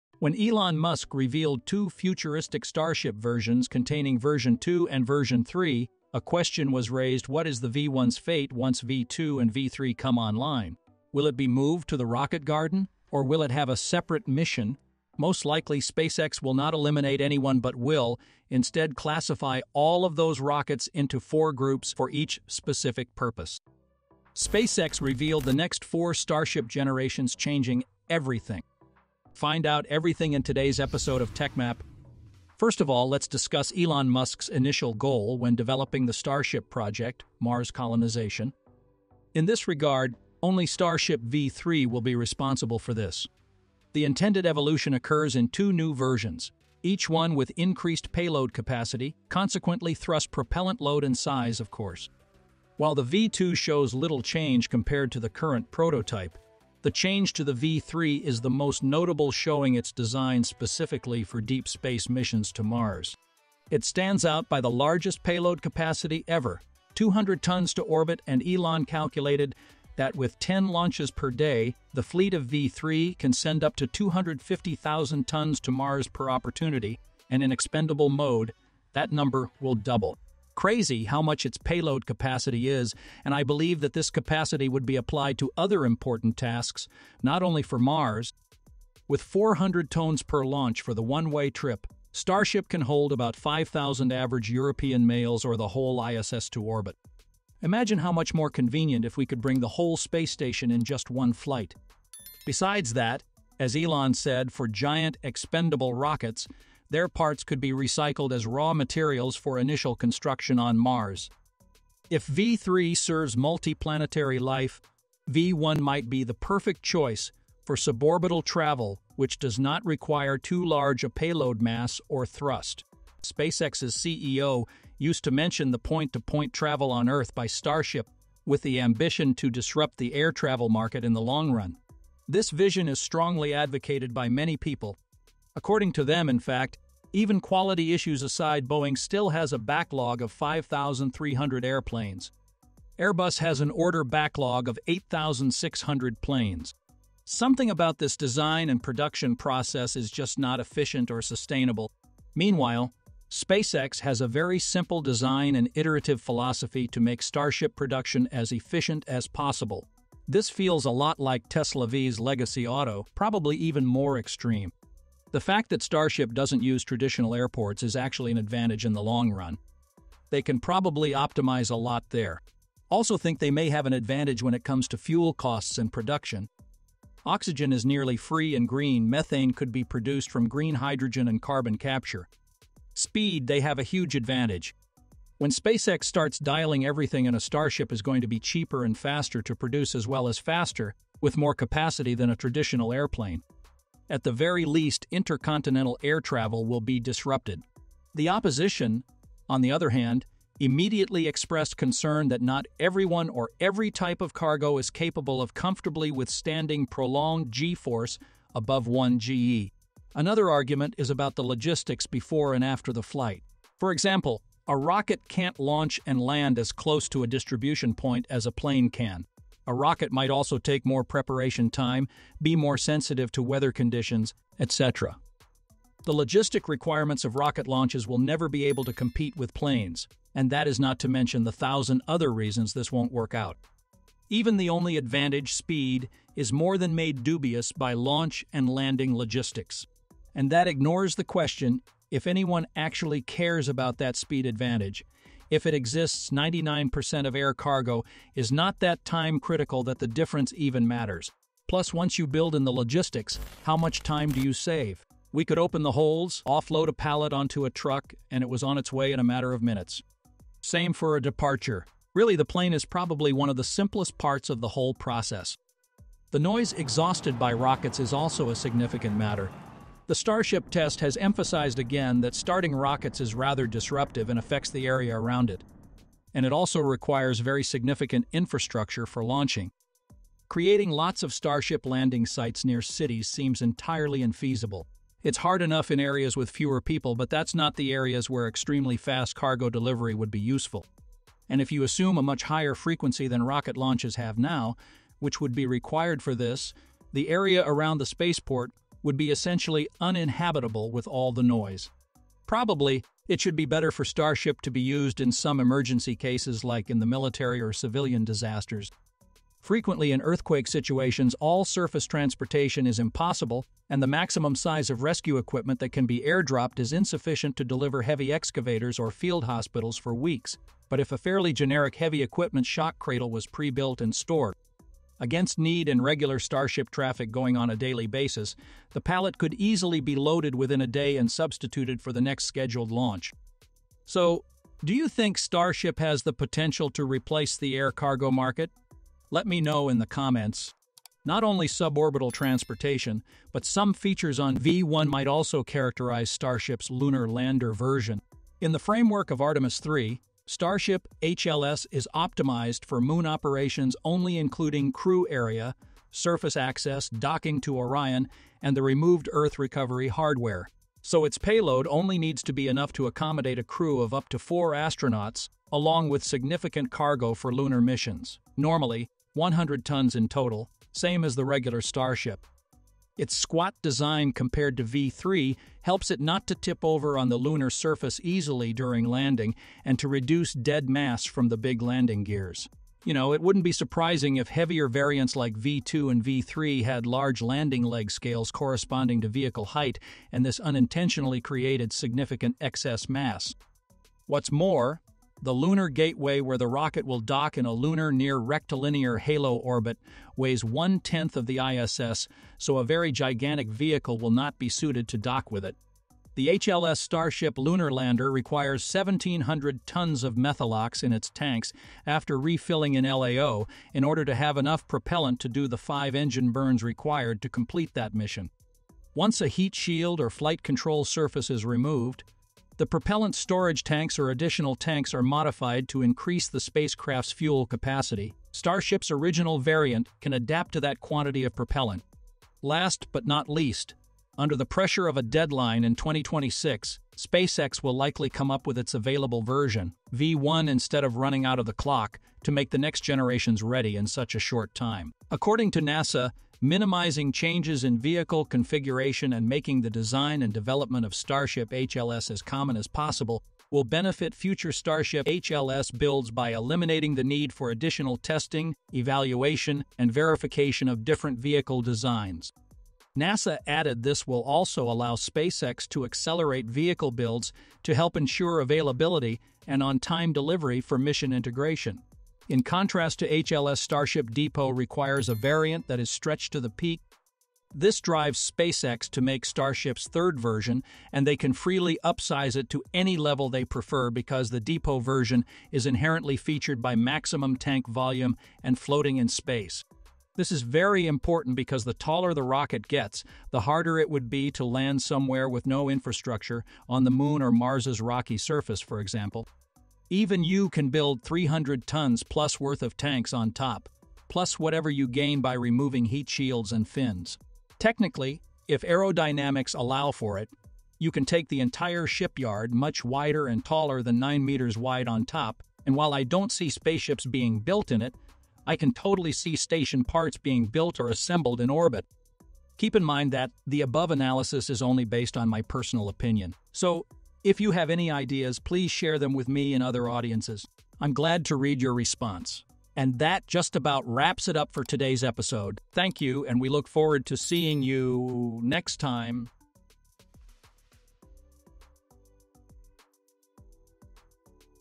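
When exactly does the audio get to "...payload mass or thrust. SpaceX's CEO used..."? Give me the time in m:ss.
2:01.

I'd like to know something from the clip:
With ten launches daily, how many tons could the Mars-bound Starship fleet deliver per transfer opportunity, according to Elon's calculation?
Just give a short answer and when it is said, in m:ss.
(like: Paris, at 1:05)
250,000 tons, at 1:13.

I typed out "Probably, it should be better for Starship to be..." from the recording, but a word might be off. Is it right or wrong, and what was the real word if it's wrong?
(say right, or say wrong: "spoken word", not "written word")
right.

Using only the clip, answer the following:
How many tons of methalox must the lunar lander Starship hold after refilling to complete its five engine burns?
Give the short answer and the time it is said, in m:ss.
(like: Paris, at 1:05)
1,700 tons, at 6:48.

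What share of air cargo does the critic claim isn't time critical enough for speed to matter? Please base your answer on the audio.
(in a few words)
99%.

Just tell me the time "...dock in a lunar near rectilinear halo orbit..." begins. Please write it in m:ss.
6:37.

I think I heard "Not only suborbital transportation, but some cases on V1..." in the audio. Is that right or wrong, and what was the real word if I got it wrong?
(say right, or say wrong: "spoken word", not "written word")
wrong: "features", not "cases".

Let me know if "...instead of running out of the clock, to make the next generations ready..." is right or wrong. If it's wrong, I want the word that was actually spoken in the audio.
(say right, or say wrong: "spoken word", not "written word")
right.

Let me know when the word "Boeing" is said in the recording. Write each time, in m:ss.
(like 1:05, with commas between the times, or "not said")
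2:18.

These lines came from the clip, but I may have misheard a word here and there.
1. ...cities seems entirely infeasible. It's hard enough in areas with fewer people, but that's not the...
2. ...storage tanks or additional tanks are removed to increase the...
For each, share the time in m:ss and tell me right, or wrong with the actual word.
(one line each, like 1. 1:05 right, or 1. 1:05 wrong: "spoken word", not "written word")
1. 4:42 right
2. 7:03 wrong: "modified", not "removed".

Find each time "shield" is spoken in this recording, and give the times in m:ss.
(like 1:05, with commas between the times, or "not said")
6:59, 8:26.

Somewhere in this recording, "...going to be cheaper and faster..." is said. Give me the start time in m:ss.
3:08.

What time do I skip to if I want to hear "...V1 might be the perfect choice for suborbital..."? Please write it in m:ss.
1:55.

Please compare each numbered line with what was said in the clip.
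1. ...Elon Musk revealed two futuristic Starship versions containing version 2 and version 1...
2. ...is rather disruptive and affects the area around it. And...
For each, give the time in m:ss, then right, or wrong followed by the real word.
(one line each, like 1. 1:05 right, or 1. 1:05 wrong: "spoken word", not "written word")
1. 0:00 wrong: "3", not "1"
2. 4:33 right.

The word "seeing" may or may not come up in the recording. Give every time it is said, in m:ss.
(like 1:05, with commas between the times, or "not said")
8:57.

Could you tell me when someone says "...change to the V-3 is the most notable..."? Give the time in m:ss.
0:56.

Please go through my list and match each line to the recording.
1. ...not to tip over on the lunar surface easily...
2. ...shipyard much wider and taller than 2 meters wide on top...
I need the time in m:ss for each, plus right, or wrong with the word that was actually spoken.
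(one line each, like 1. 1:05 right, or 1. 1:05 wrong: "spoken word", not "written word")
1. 6:16 right
2. 8:32 wrong: "9", not "2".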